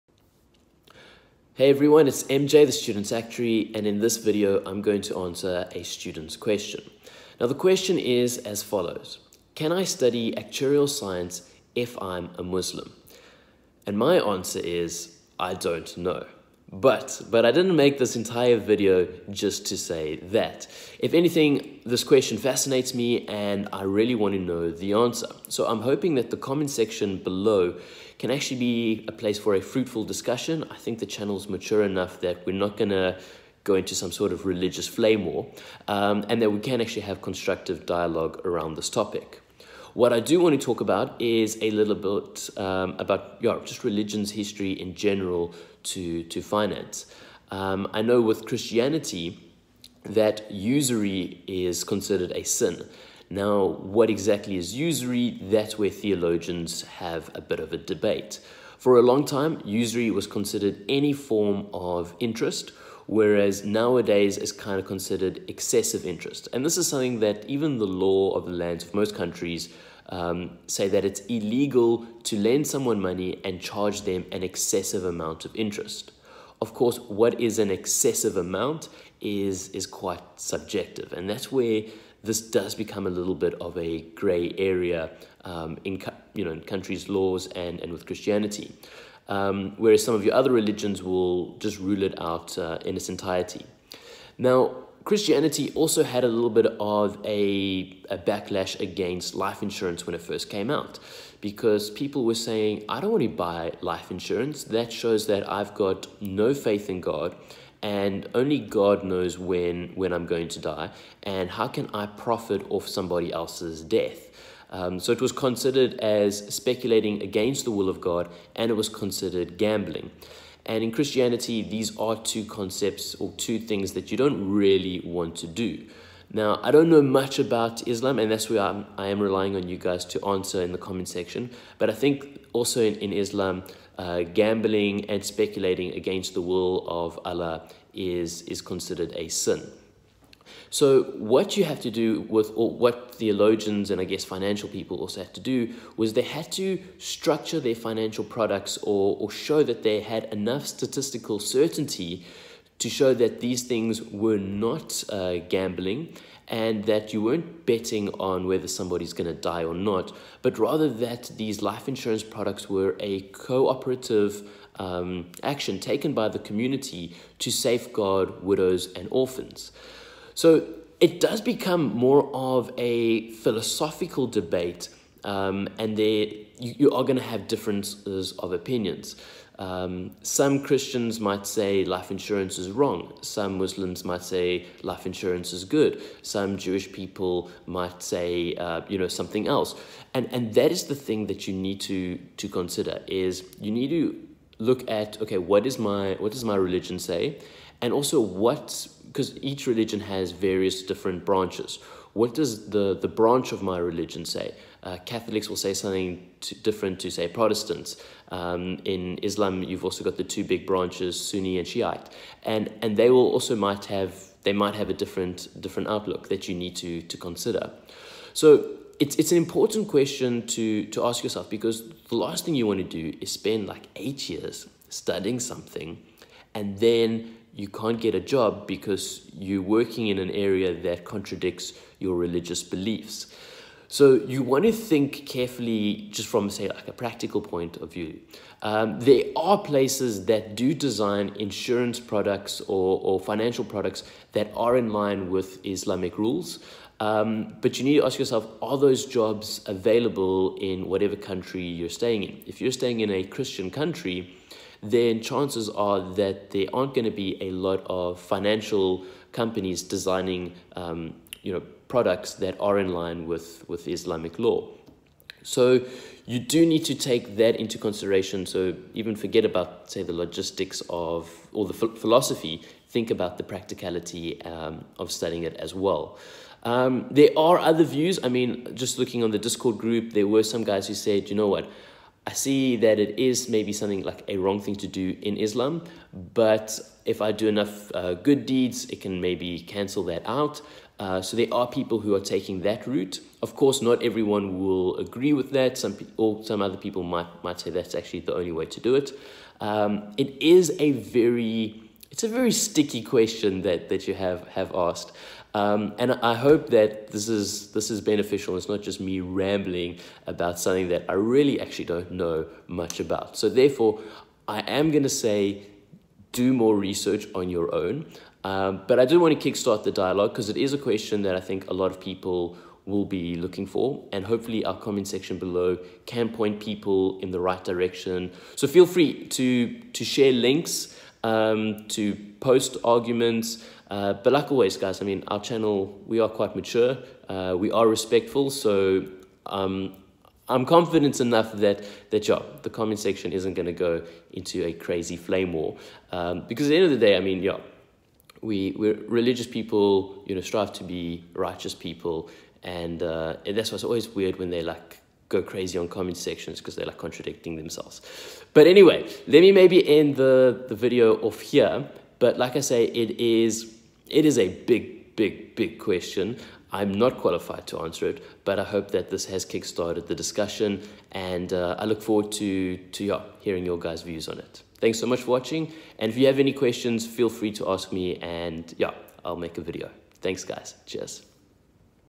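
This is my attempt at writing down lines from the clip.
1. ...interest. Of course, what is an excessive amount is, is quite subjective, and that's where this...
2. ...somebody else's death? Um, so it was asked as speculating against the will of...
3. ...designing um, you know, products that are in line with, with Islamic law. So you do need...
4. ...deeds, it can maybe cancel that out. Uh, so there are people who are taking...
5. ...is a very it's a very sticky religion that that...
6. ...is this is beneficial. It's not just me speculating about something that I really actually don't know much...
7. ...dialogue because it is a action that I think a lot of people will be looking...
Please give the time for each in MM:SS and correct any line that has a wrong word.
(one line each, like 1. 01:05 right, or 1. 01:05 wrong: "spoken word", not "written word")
1. 01:15 right
2. 01:52 wrong: "considered", not "asked"
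3. 04:19 right
4. 04:48 right
5. 05:00 wrong: "question", not "religion"
6. 05:07 wrong: "rambling", not "speculating"
7. 05:19 wrong: "question", not "action".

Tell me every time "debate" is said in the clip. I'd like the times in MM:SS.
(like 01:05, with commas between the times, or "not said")
00:57, 02:54.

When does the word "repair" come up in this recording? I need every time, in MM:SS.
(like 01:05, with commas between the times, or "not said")
not said.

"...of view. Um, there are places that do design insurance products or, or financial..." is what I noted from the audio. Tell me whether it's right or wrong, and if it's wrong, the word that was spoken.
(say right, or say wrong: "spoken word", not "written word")
right.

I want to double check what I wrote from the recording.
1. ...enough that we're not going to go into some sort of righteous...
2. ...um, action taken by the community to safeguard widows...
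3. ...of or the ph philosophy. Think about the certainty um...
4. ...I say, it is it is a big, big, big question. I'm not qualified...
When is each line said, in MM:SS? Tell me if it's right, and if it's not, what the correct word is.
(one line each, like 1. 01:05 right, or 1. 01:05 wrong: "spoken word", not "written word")
1. 00:31 wrong: "religious", not "righteous"
2. 02:44 right
3. 04:30 wrong: "practicality", not "certainty"
4. 06:02 right.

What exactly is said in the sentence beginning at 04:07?
Um, but you need to ask yourself are those jobs available in whatever country you're staying in?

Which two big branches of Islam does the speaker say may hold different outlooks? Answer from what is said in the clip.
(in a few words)
Sunni and Shiite.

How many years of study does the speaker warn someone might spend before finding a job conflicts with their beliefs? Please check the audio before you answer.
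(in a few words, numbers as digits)
8.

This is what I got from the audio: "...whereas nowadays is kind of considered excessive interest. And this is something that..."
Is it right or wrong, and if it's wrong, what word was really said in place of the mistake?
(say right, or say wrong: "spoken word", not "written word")
right.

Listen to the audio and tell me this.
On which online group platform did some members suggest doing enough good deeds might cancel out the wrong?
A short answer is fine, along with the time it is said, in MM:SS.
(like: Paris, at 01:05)
Discord, at 04:39.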